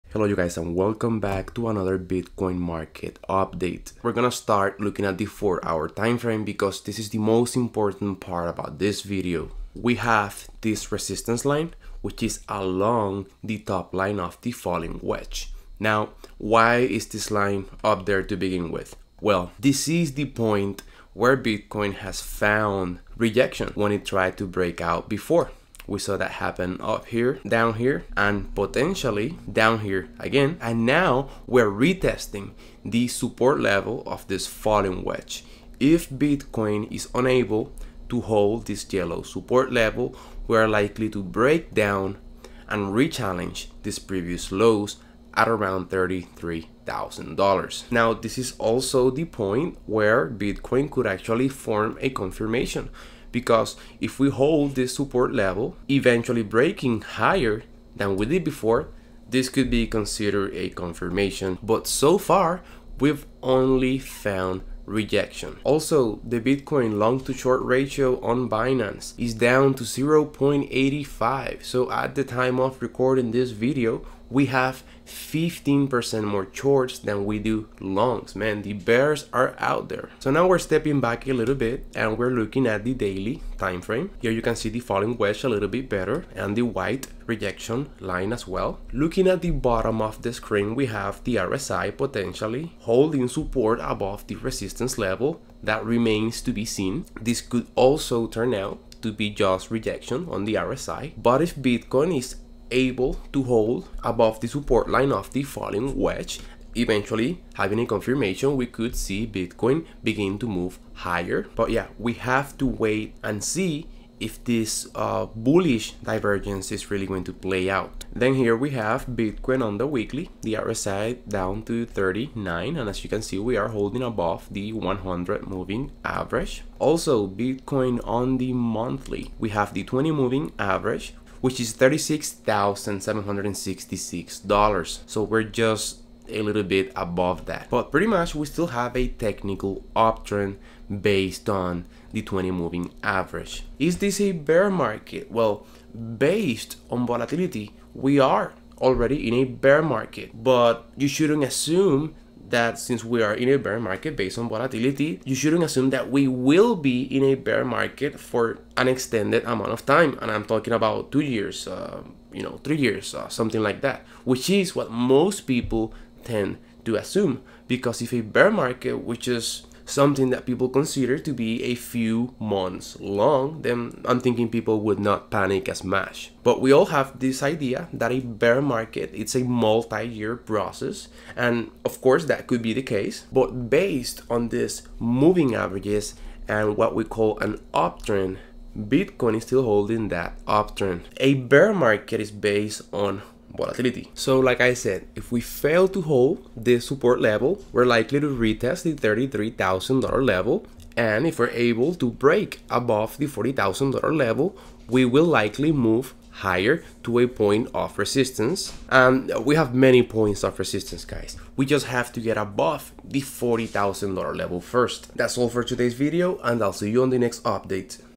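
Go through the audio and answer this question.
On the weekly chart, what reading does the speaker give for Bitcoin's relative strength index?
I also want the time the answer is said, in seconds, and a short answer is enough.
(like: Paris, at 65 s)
39, at 121 s.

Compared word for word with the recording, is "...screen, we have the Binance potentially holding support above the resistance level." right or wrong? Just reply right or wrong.
wrong.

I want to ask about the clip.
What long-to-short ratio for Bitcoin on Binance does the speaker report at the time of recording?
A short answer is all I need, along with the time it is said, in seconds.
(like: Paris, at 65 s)
0.85, at 69 s.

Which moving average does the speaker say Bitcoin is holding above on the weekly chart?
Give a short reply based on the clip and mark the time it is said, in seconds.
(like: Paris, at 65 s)
100 moving average, at 124 s.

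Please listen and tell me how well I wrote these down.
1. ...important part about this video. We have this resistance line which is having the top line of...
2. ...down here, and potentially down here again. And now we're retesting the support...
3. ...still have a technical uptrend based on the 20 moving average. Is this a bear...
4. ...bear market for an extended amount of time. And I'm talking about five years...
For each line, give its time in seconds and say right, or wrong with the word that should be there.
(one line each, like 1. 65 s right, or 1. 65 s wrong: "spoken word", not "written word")
1. 7 s wrong: "along", not "having"
2. 27 s right
3. 138 s right
4. 157 s wrong: "two", not "five".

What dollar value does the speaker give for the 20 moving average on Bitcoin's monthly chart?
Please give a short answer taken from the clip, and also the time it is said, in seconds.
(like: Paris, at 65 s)
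$36,766, at 131 s.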